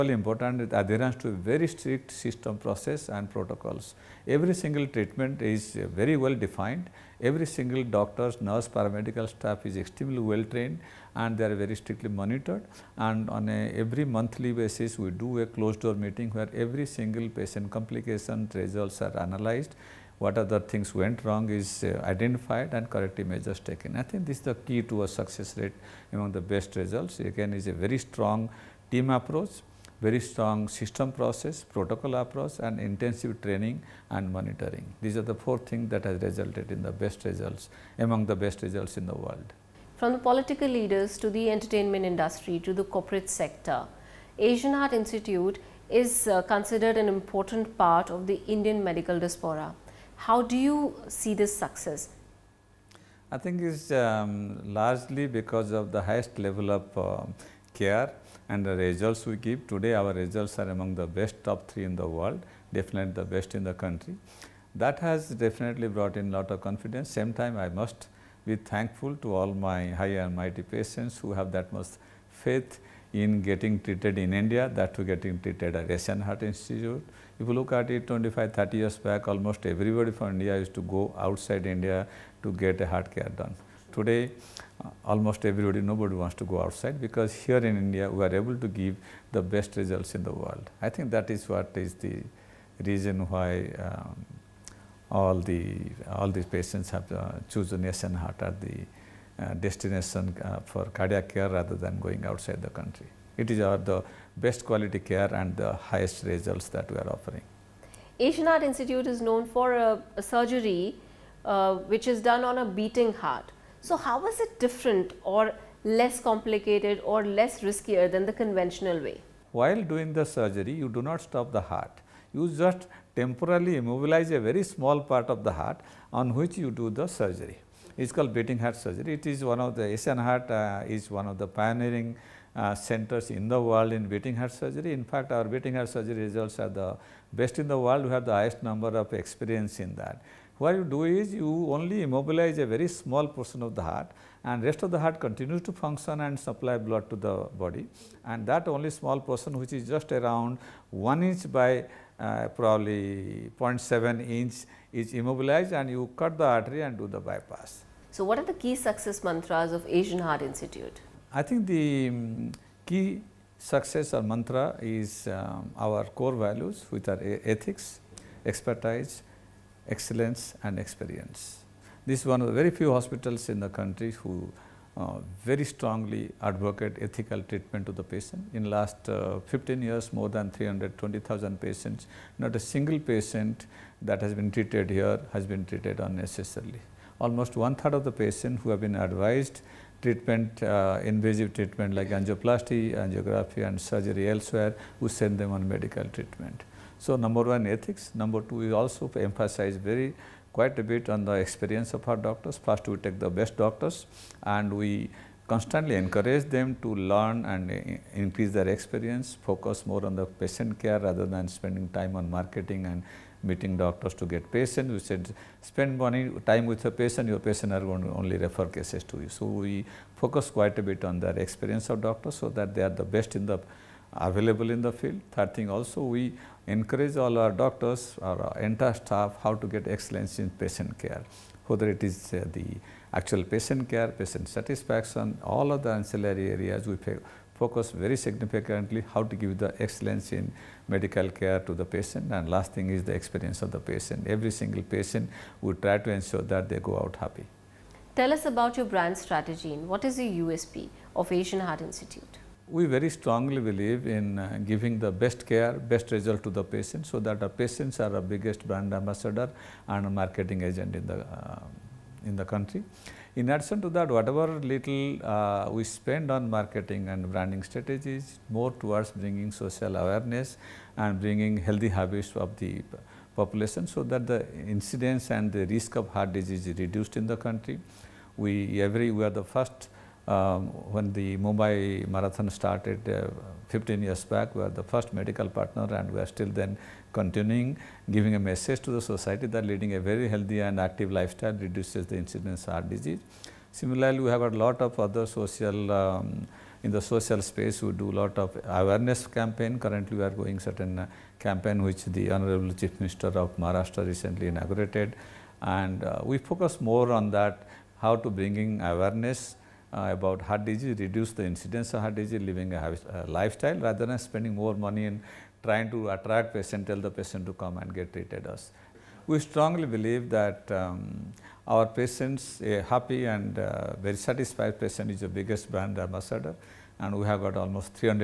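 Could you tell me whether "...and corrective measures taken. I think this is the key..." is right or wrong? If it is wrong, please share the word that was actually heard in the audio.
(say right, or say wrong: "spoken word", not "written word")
right.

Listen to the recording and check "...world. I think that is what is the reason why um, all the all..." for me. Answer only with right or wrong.
right.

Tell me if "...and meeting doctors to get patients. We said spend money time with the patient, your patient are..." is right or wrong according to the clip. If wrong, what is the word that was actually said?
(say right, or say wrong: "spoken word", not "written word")
right.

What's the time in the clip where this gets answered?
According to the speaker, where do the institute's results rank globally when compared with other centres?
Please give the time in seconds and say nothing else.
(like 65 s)
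61 s.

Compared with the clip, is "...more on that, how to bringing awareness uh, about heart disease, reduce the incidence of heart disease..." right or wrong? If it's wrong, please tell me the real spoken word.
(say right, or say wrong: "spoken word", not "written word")
right.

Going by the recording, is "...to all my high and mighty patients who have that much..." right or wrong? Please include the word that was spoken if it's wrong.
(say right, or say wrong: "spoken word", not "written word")
right.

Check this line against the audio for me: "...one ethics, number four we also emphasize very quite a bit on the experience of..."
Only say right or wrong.
wrong.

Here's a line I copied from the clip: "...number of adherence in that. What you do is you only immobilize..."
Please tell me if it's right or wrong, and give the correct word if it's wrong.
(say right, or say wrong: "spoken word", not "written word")
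wrong: "experience", not "adherence".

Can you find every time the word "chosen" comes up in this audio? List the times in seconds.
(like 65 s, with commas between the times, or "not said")
97 s.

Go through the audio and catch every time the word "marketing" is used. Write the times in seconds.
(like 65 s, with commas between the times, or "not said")
212 s, 260 s, 266 s.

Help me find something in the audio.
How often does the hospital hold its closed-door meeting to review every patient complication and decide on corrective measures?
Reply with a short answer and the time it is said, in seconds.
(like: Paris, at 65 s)
Monthly, at 13 s.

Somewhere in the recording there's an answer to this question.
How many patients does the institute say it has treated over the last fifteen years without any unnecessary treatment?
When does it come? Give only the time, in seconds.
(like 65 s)
180 s.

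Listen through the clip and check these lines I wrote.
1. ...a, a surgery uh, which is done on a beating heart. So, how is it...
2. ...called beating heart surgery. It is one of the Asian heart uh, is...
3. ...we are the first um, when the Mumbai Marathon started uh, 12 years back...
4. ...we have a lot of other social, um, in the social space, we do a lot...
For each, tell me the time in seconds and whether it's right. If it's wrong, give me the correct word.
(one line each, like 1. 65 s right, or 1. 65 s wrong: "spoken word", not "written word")
1. 109 s right
2. 128 s right
3. 279 s wrong: "15", not "12"
4. 294 s right.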